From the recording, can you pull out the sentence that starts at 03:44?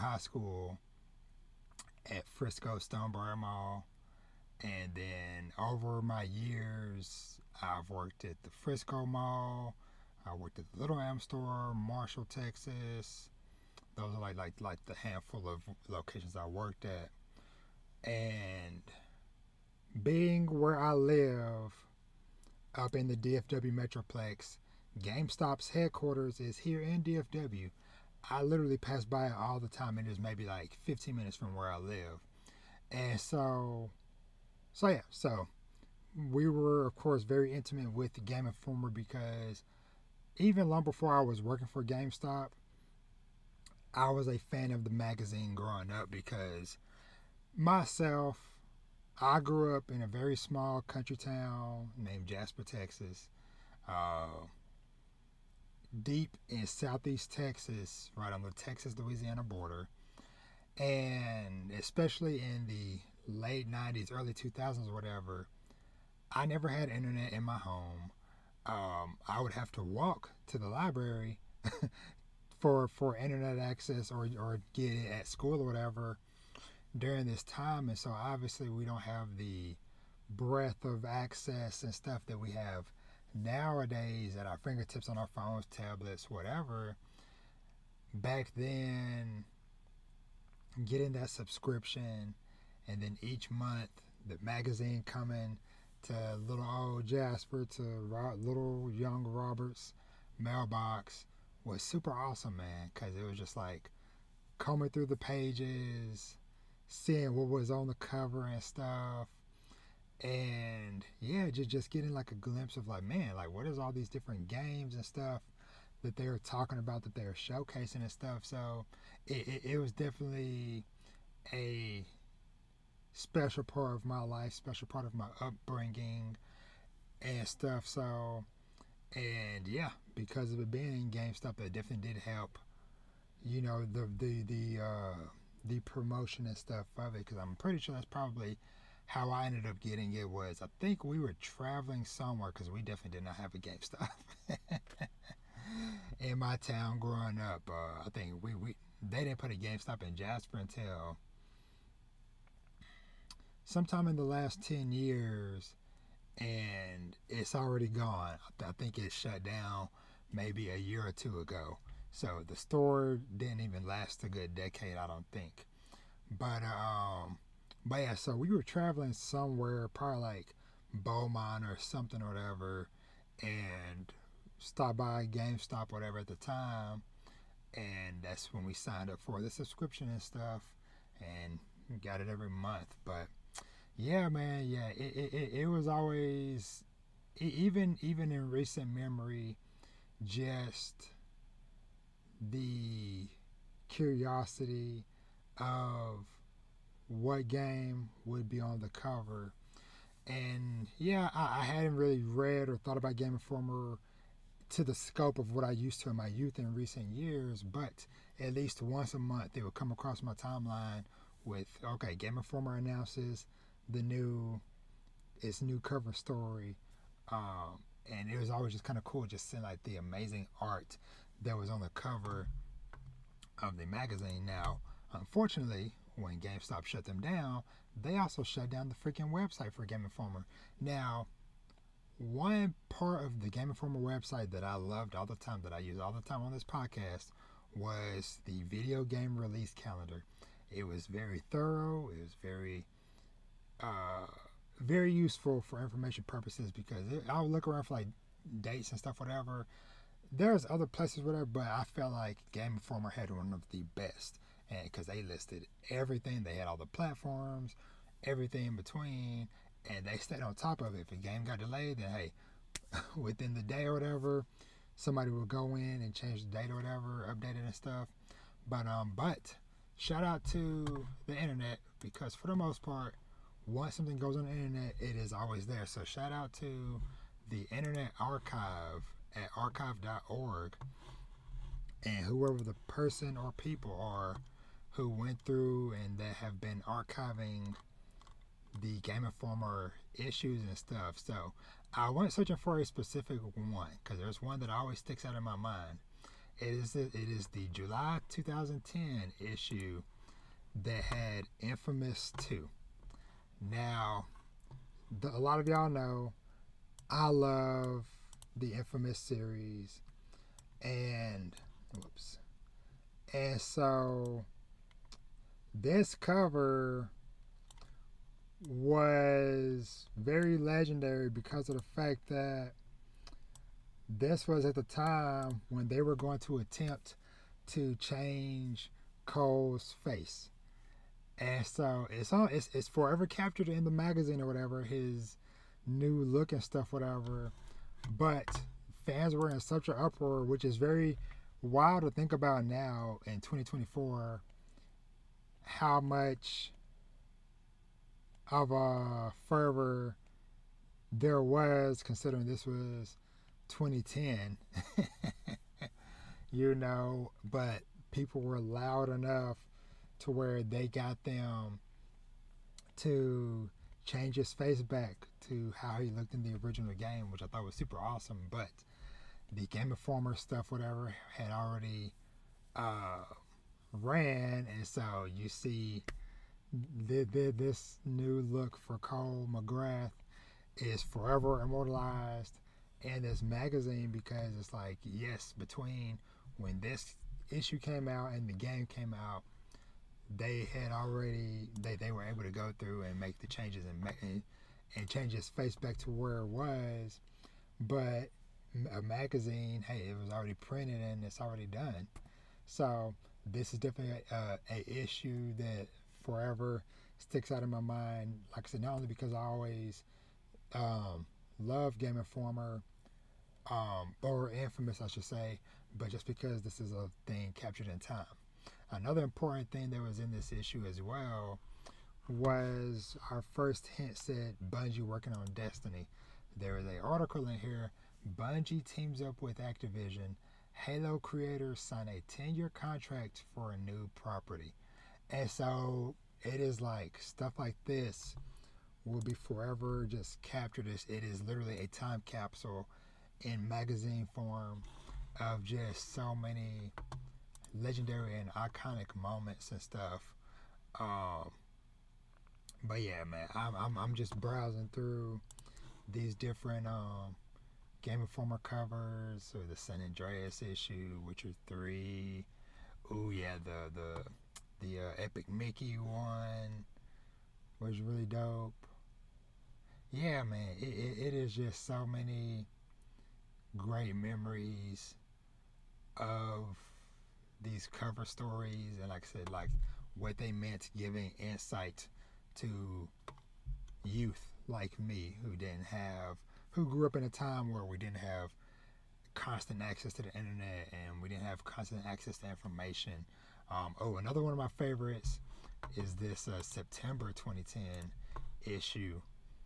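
Now, unfortunately, when GameStop shut them down, they also shut down the freaking website for Game Informer.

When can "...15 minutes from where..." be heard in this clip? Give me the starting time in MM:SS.
00:30.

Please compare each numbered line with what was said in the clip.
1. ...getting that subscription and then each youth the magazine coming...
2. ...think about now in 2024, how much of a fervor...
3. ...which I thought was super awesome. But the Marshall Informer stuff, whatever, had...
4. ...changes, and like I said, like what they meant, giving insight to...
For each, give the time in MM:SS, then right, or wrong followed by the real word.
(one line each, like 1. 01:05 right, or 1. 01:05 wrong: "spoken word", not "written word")
1. 01:30 wrong: "month", not "youth"
2. 05:42 right
3. 06:07 wrong: "Game", not "Marshall"
4. 07:58 wrong: "stories", not "changes".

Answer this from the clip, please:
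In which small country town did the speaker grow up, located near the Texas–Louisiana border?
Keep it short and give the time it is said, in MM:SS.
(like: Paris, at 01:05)
Jasper, Texas, at 00:52.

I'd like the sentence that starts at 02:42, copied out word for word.
So the store didn't even last a good decade, I don't think.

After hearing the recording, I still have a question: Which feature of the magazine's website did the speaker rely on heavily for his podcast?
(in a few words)
video game release calendar.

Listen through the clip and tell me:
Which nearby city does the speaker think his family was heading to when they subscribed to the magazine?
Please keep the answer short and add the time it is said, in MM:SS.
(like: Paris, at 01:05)
Beaumont, at 02:50.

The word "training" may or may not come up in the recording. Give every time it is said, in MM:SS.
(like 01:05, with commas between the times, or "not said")
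not said.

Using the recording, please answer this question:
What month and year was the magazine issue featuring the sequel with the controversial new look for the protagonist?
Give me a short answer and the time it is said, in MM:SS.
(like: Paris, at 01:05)
July 2010, at 04:57.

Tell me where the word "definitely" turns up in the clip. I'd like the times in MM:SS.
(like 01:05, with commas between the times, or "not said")
01:59, 02:11, 02:22, 06:43.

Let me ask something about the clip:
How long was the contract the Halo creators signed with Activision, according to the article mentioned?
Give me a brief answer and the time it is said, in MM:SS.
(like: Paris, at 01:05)
10 years, at 07:12.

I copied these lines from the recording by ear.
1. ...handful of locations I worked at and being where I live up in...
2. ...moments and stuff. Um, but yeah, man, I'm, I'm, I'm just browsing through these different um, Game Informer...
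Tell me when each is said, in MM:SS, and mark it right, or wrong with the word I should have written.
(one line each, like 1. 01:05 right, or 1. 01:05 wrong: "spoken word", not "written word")
1. 00:14 right
2. 07:29 right.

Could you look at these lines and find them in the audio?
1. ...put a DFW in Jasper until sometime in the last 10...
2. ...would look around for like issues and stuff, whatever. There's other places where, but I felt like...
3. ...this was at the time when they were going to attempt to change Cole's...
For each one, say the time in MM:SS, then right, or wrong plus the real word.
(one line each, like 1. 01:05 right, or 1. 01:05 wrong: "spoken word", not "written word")
1. 02:29 wrong: "GameStop", not "DFW"
2. 04:07 wrong: "dates", not "issues"
3. 05:24 right.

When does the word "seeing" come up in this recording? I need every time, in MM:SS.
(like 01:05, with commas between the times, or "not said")
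01:46, 03:39.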